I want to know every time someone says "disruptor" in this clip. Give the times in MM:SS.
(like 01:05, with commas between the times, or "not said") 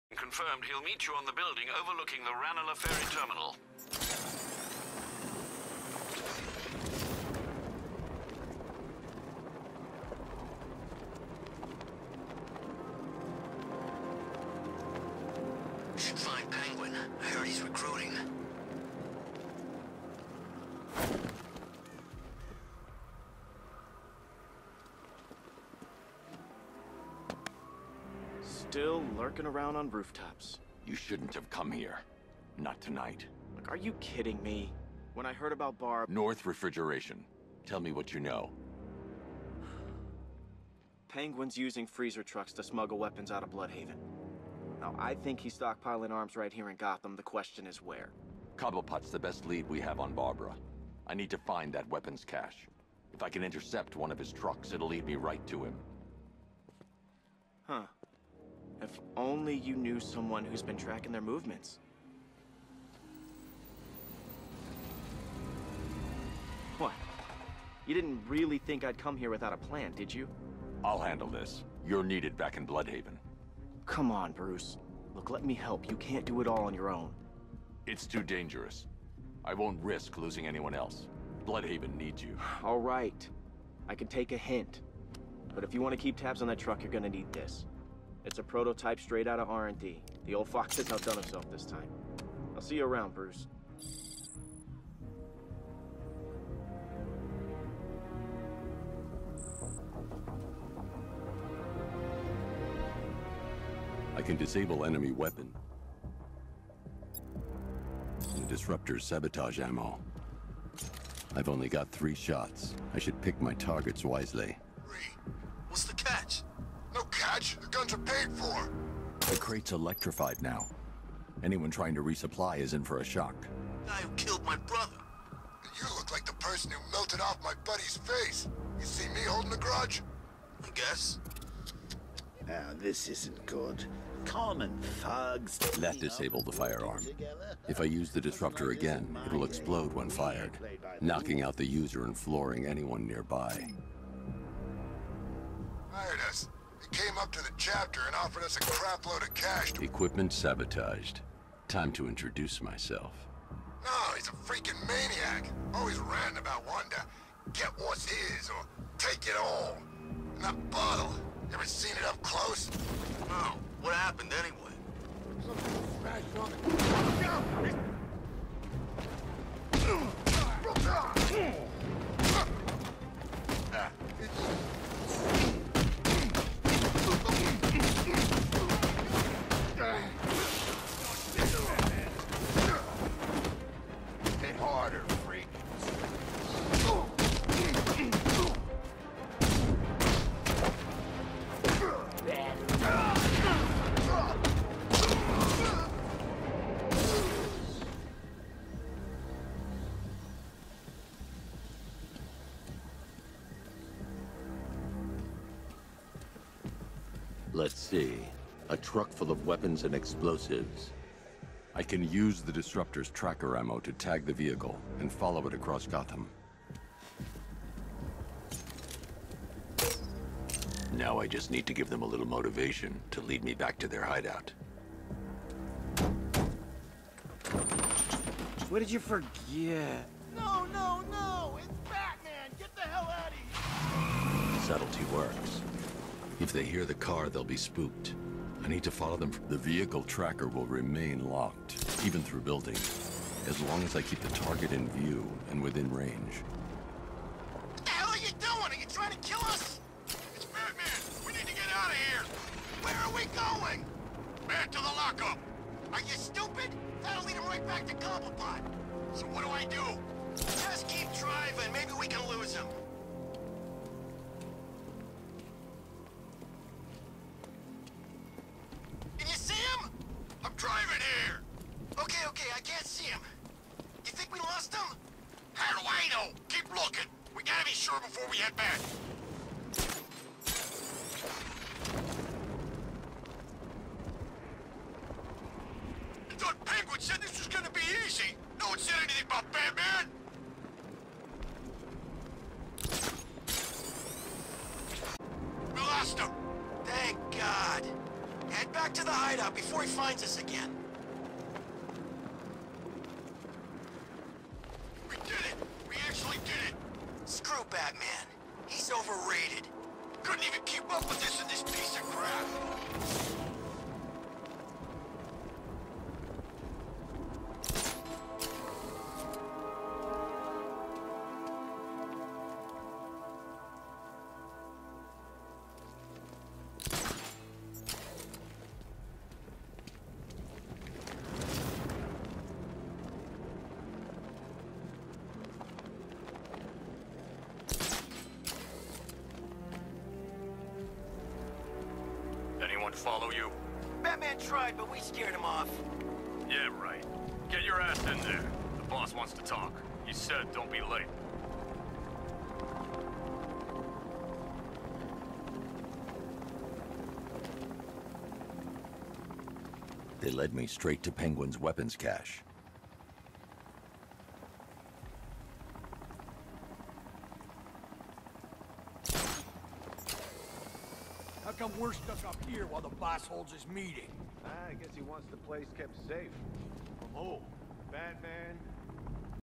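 01:48, 02:18, 03:32.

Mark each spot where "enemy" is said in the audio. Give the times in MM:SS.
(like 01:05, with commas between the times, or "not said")
01:44.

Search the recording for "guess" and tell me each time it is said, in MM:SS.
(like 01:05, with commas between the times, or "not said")
02:10, 06:14.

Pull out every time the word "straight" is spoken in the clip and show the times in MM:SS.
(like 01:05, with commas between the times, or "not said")
01:28, 06:00.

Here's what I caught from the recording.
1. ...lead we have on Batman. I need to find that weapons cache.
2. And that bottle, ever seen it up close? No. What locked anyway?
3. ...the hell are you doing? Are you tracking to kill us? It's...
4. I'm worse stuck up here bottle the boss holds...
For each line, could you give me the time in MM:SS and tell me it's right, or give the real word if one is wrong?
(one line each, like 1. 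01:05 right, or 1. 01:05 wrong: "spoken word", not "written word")
1. 00:49 wrong: "Barbara", not "Batman"
2. 02:40 wrong: "happened", not "locked"
3. 04:07 wrong: "trying", not "tracking"
4. 06:11 wrong: "while", not "bottle".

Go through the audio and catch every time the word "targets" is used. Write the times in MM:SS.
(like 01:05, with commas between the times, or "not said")
01:53, 04:04.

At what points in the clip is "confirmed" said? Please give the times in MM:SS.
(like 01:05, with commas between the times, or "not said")
00:00.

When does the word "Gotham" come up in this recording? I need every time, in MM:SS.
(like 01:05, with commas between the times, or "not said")
00:46, 03:35.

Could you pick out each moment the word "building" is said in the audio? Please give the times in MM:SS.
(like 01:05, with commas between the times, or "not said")
00:01, 04:02.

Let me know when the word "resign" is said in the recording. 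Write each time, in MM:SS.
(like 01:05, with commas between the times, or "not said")
not said.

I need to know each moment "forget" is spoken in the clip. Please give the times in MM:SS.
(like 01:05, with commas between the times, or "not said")
03:48.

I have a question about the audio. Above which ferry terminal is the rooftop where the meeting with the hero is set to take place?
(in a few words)
Ranelagh Ferry Terminal.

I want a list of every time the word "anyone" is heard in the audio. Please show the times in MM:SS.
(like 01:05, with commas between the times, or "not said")
01:20, 02:01, 02:22.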